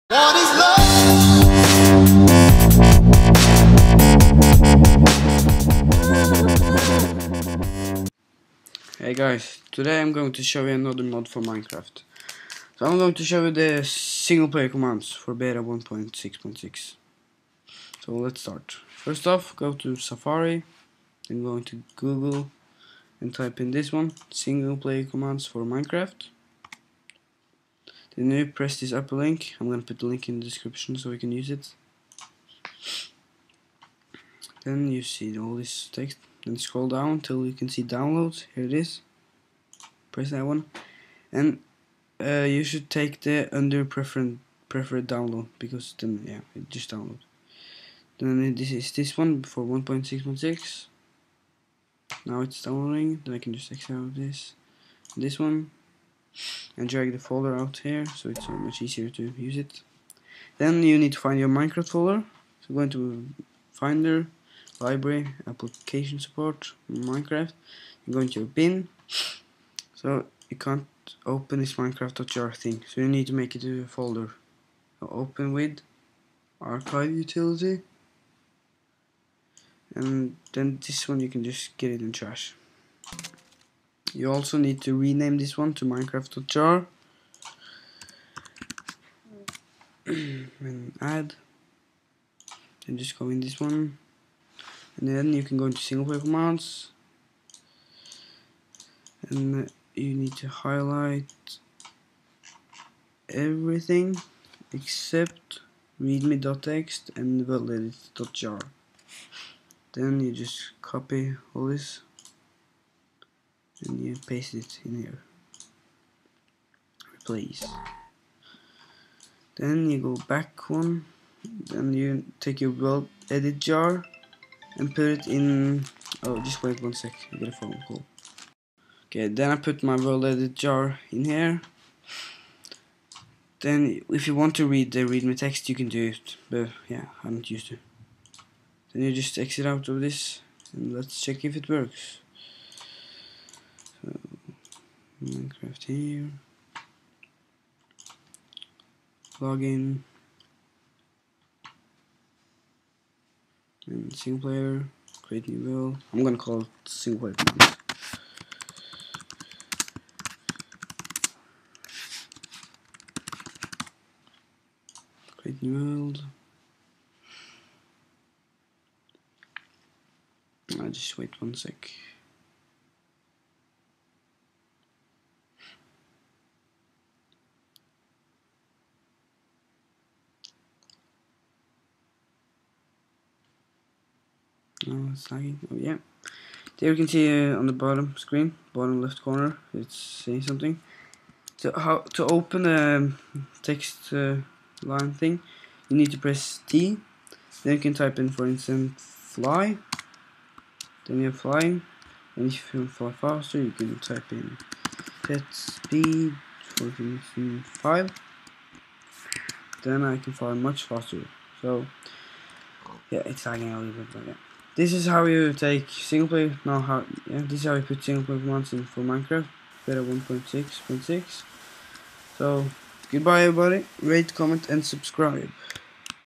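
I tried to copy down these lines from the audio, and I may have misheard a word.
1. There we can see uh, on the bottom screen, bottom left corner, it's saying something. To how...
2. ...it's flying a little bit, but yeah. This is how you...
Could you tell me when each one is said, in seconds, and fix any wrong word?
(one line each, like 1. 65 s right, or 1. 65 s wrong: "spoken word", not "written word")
1. 186 s right
2. 213 s wrong: "lagging", not "flying".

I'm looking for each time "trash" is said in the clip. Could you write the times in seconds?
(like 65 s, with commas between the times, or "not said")
82 s.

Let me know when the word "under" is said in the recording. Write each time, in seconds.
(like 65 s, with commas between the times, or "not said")
43 s.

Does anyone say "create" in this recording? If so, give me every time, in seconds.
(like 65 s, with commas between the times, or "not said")
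155 s, 165 s.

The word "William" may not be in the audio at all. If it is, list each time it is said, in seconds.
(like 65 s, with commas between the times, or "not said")
not said.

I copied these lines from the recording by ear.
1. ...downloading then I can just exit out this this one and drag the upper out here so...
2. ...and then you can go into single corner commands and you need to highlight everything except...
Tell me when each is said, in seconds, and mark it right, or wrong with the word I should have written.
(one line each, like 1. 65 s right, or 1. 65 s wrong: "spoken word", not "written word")
1. 52 s wrong: "folder", not "upper"
2. 94 s wrong: "player", not "corner".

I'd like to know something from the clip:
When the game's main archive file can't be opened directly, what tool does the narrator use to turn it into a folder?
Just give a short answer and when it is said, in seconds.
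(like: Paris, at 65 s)
archive utility, at 76 s.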